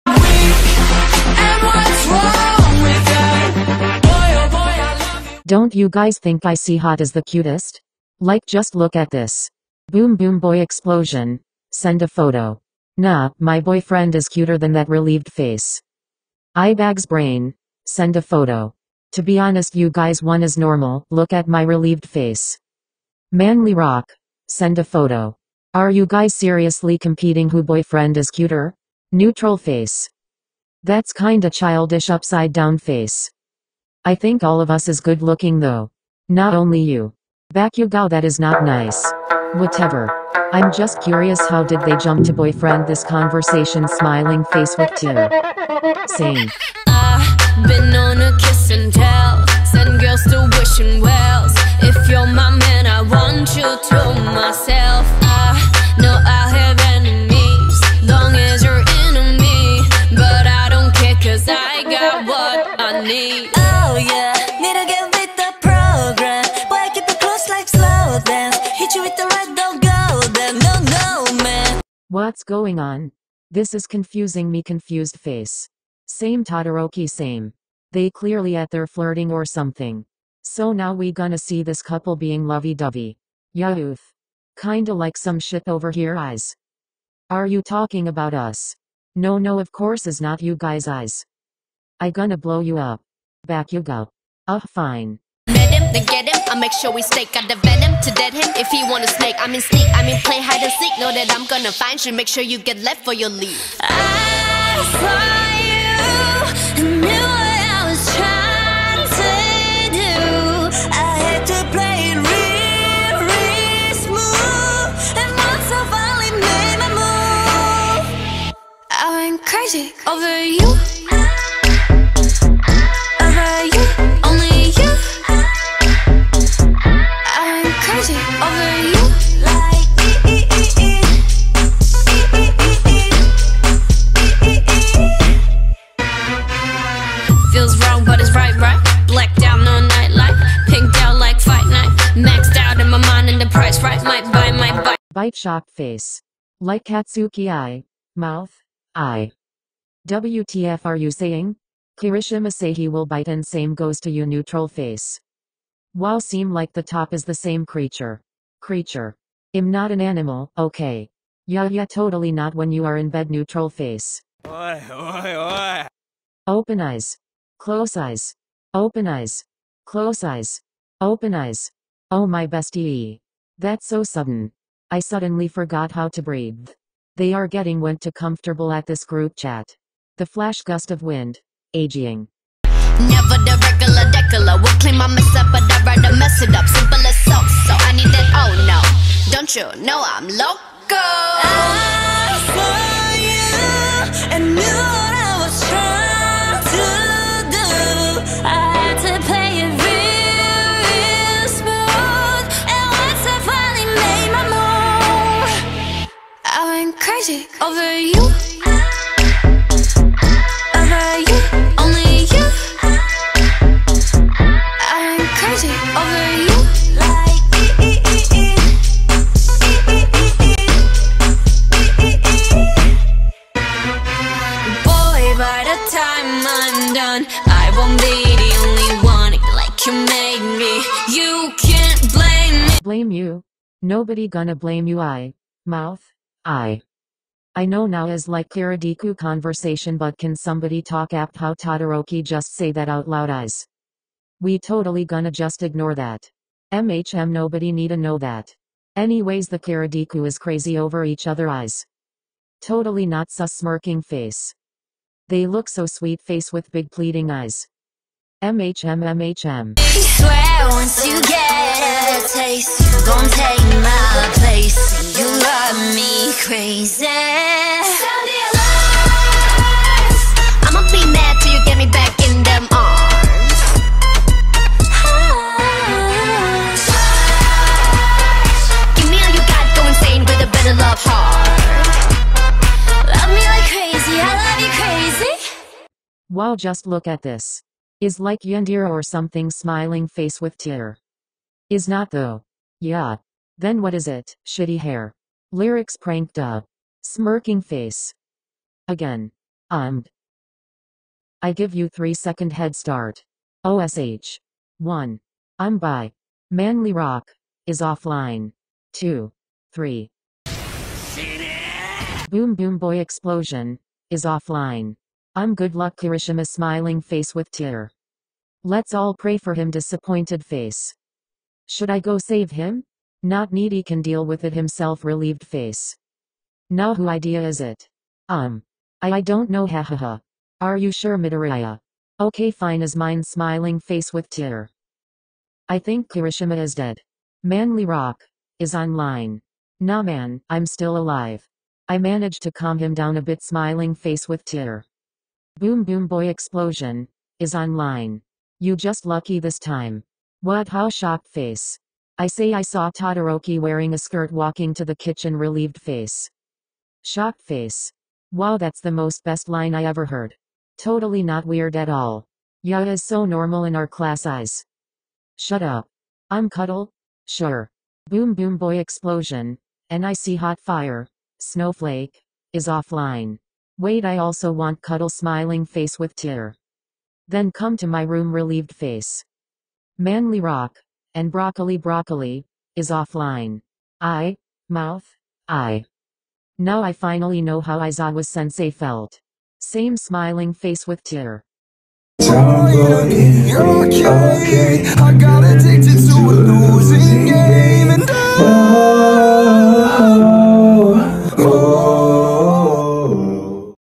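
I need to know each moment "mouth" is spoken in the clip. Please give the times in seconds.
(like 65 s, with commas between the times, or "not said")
148 s, 235 s, 384 s.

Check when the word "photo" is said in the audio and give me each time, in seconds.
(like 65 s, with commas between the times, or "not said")
12 s, 18 s, 24 s.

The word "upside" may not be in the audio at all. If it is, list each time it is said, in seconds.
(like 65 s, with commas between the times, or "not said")
32 s.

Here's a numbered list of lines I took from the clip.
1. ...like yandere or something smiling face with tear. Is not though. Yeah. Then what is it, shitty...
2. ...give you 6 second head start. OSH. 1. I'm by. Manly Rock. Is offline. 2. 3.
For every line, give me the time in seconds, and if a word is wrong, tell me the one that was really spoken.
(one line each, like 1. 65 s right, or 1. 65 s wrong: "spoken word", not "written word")
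1. 288 s right
2. 301 s wrong: "3", not "6".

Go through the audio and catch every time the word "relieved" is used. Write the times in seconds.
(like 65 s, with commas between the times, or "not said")
14 s, 21 s, 325 s, 355 s, 378 s.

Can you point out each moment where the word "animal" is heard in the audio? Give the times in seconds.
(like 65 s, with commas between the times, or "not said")
160 s.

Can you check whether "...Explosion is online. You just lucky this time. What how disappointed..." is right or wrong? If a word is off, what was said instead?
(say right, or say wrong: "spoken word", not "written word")
wrong: "shocked", not "disappointed".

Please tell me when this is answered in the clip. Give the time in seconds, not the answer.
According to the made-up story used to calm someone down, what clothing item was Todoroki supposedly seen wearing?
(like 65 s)
353 s.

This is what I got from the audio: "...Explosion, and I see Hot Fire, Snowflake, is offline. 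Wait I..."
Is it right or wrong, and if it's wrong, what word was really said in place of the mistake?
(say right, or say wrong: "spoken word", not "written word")
right.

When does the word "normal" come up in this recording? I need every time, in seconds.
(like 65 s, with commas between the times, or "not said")
20 s, 363 s.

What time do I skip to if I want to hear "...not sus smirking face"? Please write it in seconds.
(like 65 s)
253 s.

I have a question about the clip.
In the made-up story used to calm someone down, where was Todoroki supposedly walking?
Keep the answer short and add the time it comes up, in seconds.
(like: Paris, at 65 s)
the kitchen, at 354 s.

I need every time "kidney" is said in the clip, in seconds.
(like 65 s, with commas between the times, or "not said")
not said.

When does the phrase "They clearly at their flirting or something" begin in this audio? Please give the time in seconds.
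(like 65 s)
77 s.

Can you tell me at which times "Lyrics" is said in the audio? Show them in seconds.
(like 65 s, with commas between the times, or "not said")
295 s.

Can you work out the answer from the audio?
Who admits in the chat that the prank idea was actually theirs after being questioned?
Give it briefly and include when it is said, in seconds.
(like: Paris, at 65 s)
Midoriya, at 331 s.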